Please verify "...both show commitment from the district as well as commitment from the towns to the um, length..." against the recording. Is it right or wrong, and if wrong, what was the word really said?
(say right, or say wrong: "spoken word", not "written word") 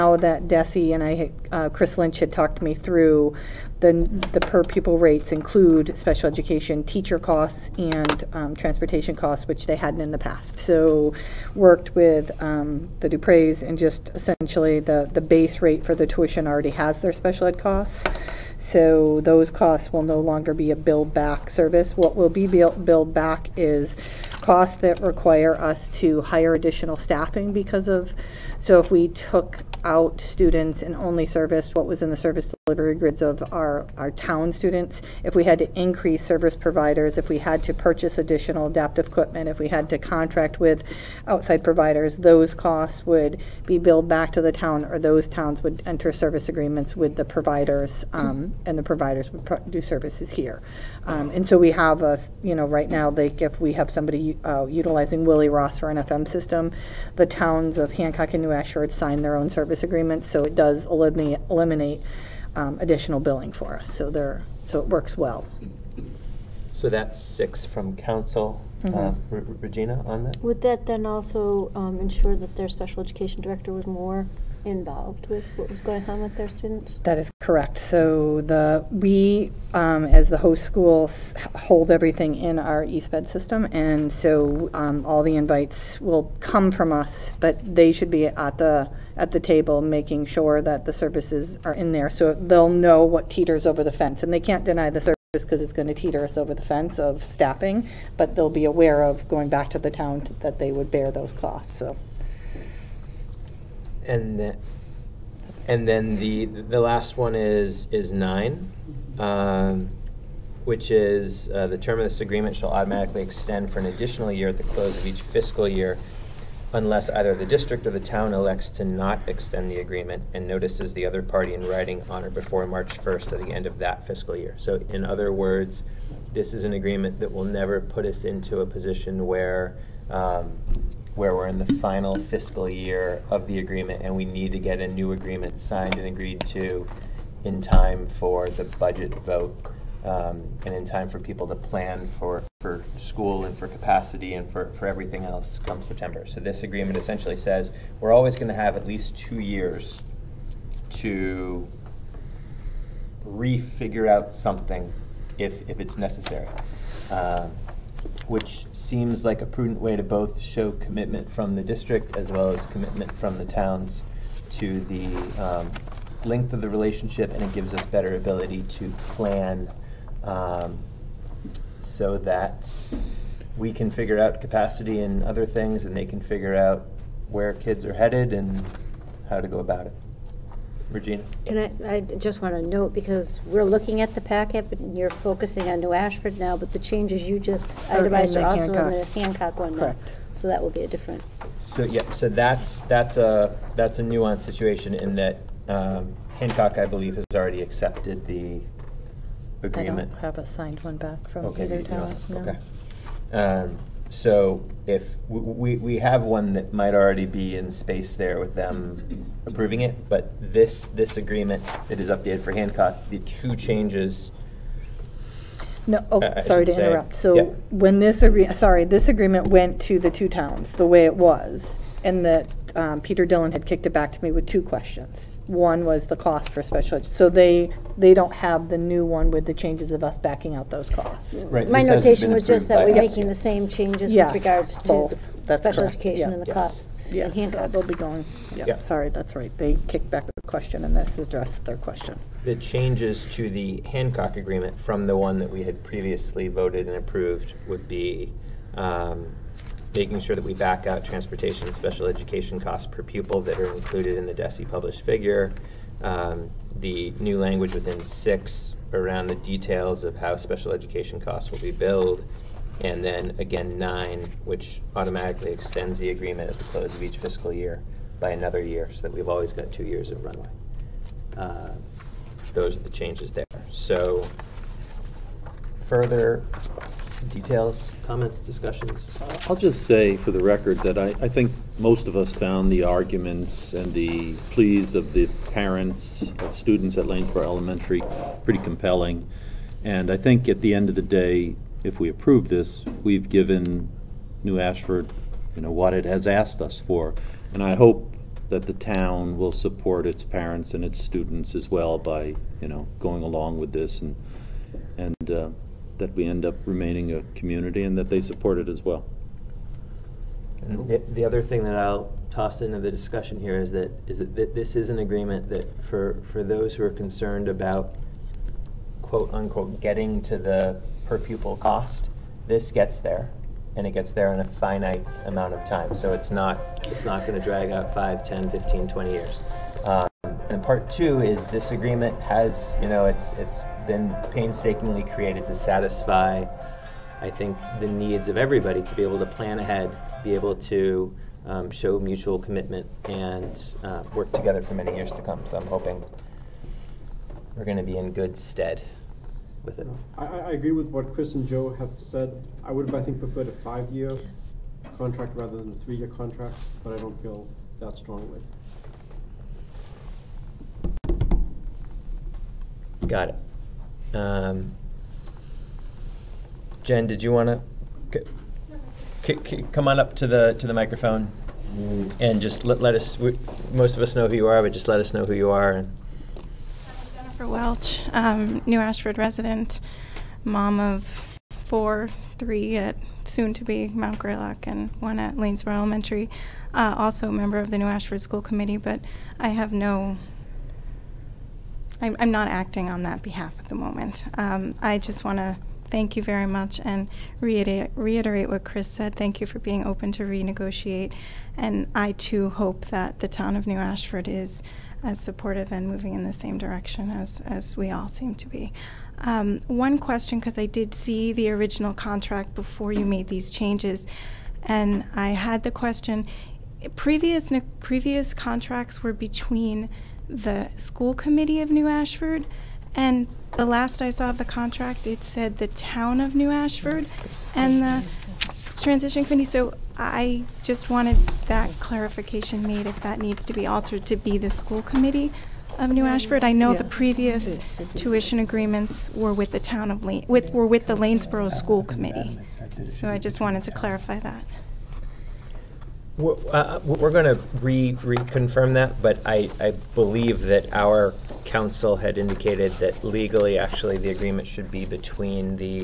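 right.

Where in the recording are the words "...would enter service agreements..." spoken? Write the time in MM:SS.
00:45.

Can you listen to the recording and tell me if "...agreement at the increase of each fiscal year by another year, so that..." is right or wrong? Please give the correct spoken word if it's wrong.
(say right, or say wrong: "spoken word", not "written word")
wrong: "close", not "increase".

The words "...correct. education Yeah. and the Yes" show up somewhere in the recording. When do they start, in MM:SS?
03:55.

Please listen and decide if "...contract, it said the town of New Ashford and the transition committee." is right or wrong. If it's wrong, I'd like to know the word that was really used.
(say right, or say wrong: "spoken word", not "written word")
right.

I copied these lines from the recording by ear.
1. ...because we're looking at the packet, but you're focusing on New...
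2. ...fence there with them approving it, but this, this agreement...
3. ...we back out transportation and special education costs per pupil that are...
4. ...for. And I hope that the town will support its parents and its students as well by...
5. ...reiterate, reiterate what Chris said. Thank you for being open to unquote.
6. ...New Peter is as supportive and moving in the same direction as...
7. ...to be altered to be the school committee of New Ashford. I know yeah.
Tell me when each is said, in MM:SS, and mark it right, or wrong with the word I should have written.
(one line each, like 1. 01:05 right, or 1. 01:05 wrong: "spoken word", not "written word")
1. 03:02 right
2. 03:27 wrong: "space", not "fence"
3. 04:10 right
4. 04:56 right
5. 06:37 wrong: "renegotiate", not "unquote"
6. 06:43 wrong: "Ashford", not "Peter"
7. 07:13 right.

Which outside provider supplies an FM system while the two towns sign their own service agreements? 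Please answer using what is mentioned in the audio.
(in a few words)
Willie Ross.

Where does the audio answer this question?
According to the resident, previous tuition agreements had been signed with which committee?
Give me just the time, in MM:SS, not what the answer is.
07:20.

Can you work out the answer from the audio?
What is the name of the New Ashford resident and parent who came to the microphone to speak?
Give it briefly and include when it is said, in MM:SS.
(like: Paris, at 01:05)
Jennifer Welch, at 06:17.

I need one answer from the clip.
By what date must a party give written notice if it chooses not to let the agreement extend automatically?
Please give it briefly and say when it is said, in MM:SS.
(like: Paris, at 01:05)
March 1st, at 02:02.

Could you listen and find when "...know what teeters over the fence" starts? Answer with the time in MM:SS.
01:32.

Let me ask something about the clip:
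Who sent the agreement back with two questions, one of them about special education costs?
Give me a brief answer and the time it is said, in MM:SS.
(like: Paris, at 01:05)
Peter Dillon, at 03:43.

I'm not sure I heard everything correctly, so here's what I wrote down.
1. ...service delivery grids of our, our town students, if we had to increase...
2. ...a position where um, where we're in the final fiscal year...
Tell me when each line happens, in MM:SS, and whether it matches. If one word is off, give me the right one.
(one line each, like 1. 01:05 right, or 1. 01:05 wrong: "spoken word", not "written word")
1. 00:32 right
2. 02:08 right.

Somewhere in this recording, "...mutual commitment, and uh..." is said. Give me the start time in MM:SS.
05:41.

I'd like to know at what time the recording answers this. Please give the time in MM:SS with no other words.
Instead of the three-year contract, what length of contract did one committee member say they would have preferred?
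05:53.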